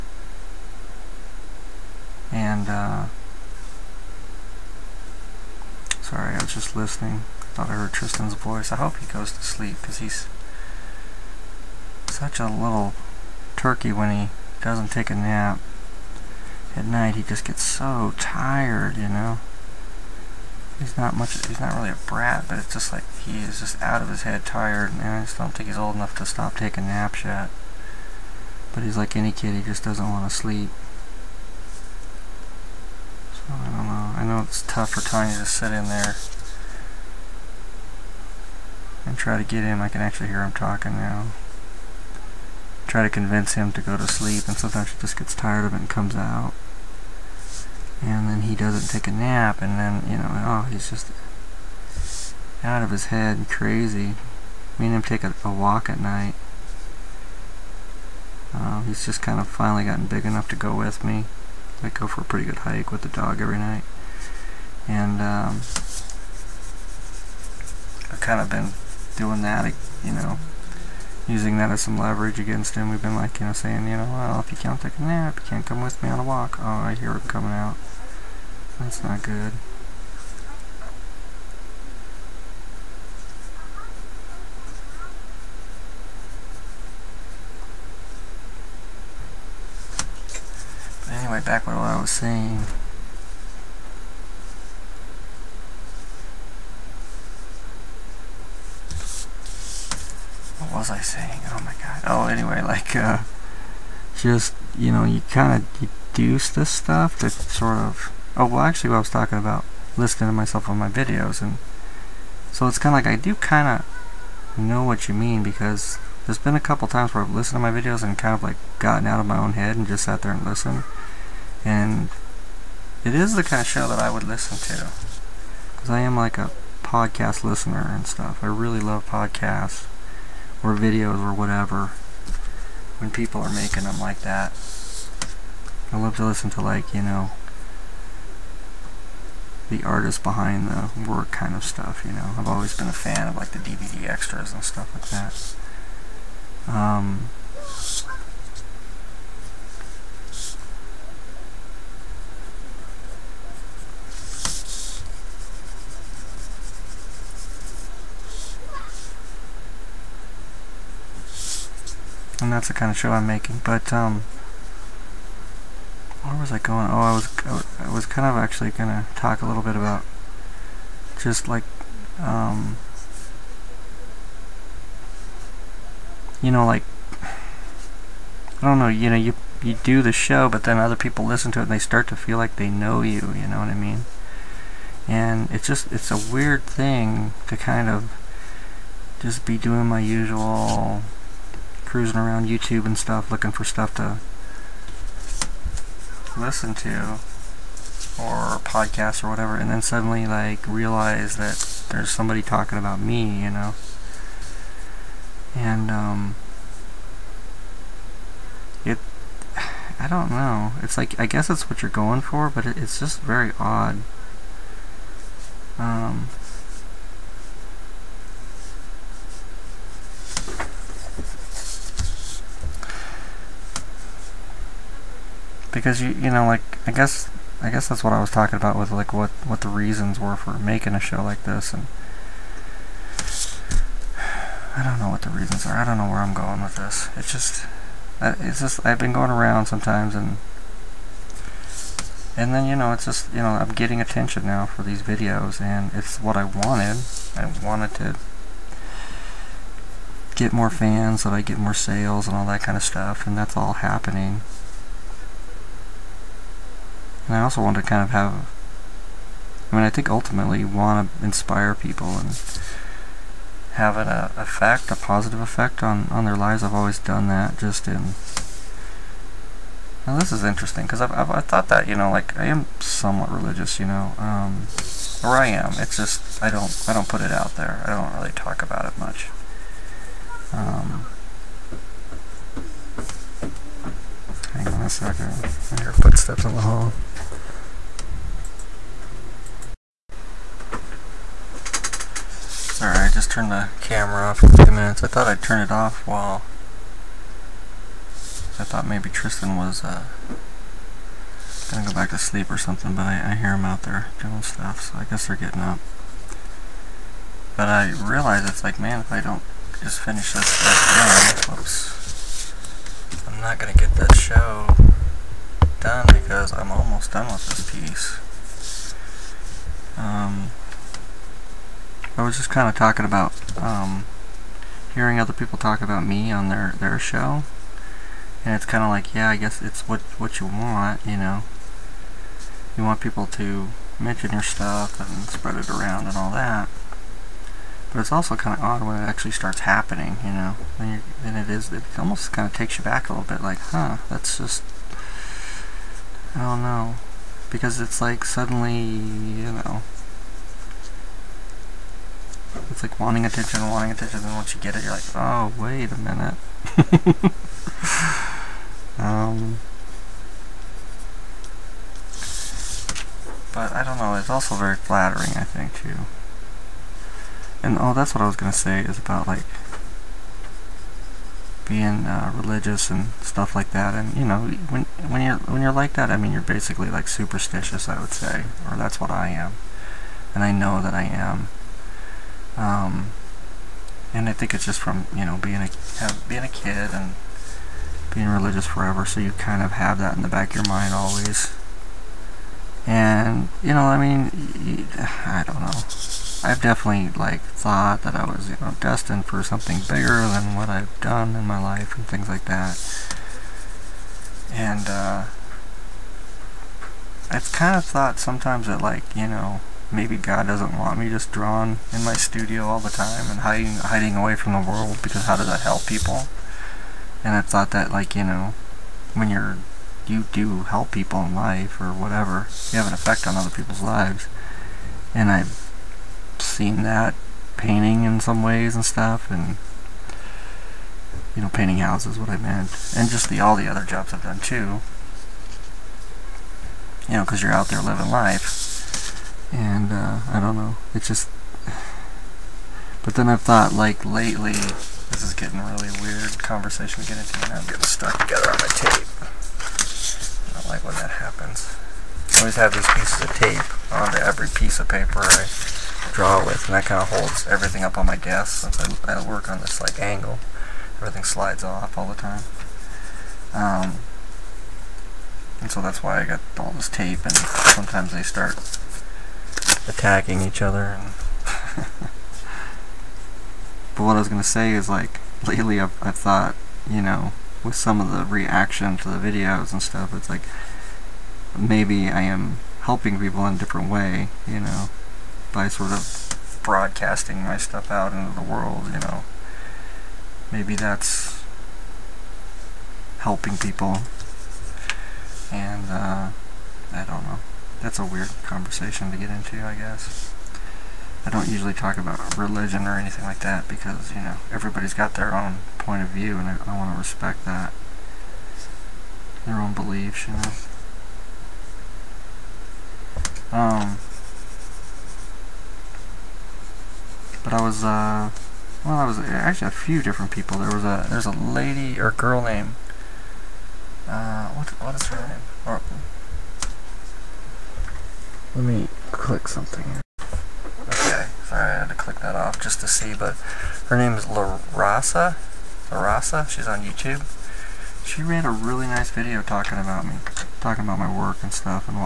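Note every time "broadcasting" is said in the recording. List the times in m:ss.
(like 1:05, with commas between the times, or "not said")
8:06.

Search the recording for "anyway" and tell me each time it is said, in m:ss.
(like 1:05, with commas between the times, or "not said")
1:31, 1:42.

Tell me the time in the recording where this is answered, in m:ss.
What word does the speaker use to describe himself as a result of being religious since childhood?
6:17.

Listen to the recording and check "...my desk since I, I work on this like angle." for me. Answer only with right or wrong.
right.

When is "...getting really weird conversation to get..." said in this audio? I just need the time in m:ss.
7:25.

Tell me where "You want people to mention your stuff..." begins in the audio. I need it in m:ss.
5:32.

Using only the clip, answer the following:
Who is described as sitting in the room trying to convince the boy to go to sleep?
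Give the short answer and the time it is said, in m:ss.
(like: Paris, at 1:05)
Tanya, at 0:35.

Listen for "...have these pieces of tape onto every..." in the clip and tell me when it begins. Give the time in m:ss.
7:32.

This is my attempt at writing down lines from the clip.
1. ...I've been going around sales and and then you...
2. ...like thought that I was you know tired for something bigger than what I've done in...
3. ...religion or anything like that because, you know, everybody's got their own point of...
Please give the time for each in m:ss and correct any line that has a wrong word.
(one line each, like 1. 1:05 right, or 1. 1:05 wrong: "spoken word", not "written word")
1. 3:58 wrong: "sometimes", not "sales"
2. 6:37 wrong: "destined", not "tired"
3. 8:22 right.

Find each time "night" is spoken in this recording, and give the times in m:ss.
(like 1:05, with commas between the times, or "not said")
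0:16, 0:55, 1:03.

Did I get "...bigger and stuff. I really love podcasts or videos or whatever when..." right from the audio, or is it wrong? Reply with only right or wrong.
wrong.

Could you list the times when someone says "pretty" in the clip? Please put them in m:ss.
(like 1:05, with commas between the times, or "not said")
1:02.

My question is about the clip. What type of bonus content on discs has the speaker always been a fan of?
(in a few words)
DVD extras.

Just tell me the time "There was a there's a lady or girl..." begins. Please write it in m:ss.
8:40.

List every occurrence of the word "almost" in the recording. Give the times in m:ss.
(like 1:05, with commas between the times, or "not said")
5:16, 5:41.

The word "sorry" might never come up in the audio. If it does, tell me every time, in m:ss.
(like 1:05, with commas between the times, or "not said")
0:06, 8:51.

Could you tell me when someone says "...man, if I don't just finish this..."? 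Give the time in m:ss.
5:08.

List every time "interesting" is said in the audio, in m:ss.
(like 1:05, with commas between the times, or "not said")
4:30.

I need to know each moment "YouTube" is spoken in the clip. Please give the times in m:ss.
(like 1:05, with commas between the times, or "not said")
3:12, 8:56.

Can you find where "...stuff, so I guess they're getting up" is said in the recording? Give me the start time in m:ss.
5:04.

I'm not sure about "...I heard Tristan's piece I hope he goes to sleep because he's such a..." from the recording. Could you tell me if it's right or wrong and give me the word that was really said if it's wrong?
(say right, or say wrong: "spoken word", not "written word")
wrong: "voice", not "piece".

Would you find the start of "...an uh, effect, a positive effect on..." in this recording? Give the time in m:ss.
4:23.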